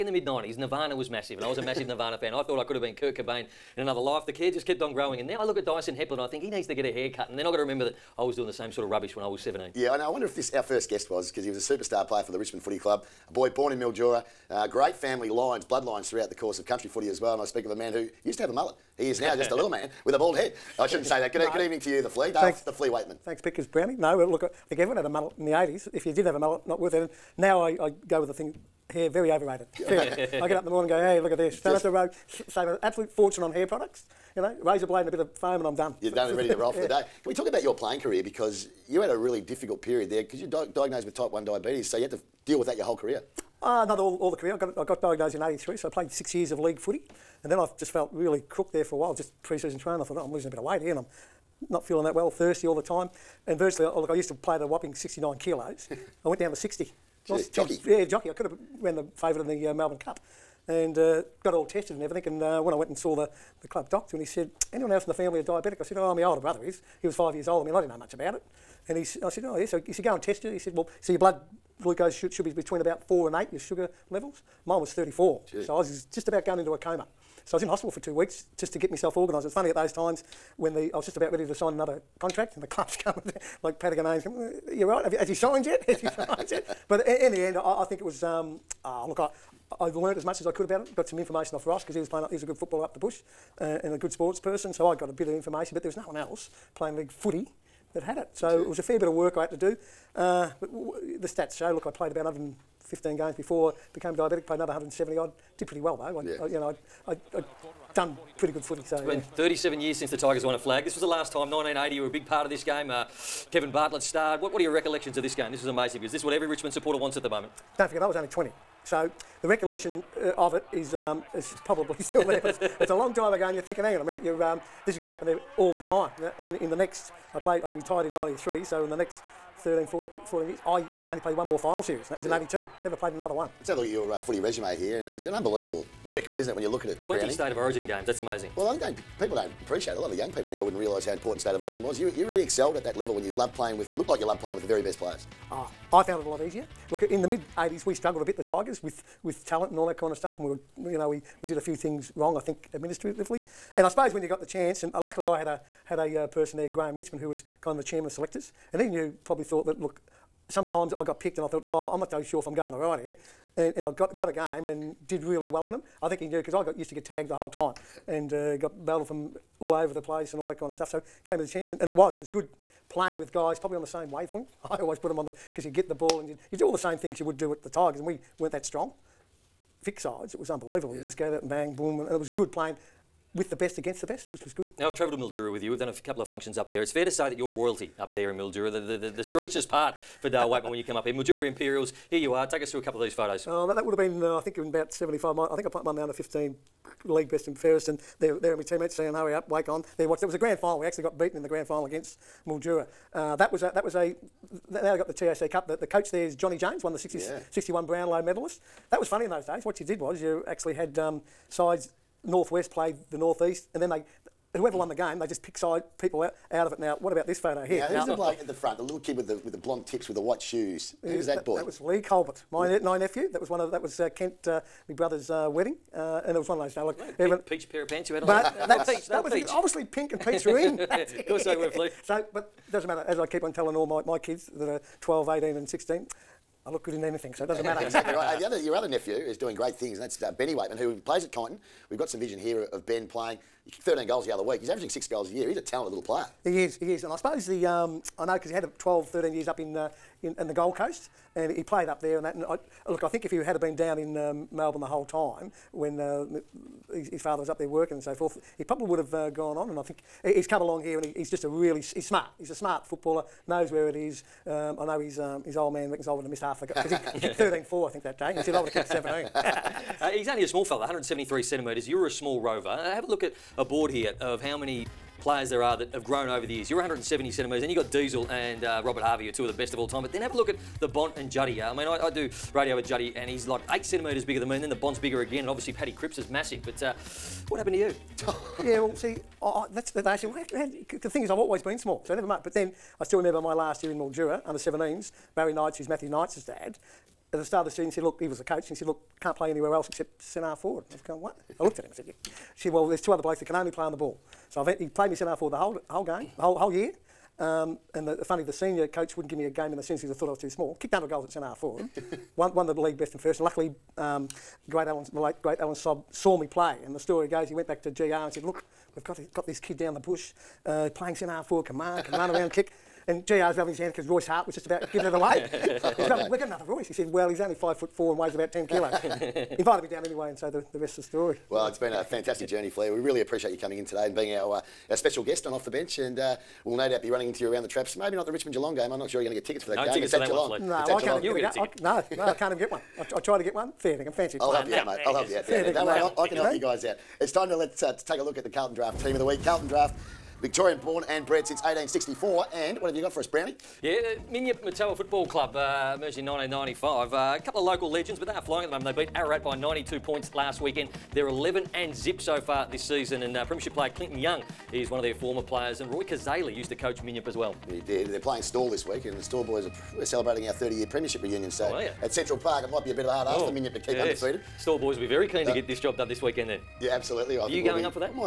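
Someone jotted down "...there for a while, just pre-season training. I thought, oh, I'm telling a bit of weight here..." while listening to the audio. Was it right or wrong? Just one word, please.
wrong.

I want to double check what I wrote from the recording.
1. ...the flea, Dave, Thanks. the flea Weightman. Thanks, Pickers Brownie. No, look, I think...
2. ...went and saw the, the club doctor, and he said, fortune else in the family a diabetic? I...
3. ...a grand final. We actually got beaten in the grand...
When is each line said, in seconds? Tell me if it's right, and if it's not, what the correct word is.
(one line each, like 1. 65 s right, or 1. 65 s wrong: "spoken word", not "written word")
1. 22 s right
2. 62 s wrong: "anyone", not "fortune"
3. 200 s right.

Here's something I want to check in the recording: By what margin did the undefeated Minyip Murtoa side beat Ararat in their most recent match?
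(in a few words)
92 points.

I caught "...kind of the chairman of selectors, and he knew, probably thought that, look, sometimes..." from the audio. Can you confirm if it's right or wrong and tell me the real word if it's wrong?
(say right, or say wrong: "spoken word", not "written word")
right.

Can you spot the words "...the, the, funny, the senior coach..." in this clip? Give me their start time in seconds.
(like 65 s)
308 s.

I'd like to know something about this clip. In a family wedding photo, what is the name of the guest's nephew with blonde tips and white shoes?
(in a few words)
Lee Colbert.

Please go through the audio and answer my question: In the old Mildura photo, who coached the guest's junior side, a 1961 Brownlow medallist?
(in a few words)
Johnny James.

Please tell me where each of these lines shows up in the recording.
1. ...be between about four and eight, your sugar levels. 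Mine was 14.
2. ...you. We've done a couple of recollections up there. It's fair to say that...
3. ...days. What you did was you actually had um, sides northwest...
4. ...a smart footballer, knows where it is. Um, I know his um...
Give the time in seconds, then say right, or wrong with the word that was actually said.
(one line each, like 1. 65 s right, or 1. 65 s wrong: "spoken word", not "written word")
1. 72 s wrong: "34", not "14"
2. 185 s wrong: "functions", not "recollections"
3. 209 s right
4. 262 s right.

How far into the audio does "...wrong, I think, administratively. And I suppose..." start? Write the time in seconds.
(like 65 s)
152 s.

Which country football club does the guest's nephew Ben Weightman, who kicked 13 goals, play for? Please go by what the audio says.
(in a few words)
Kyneton.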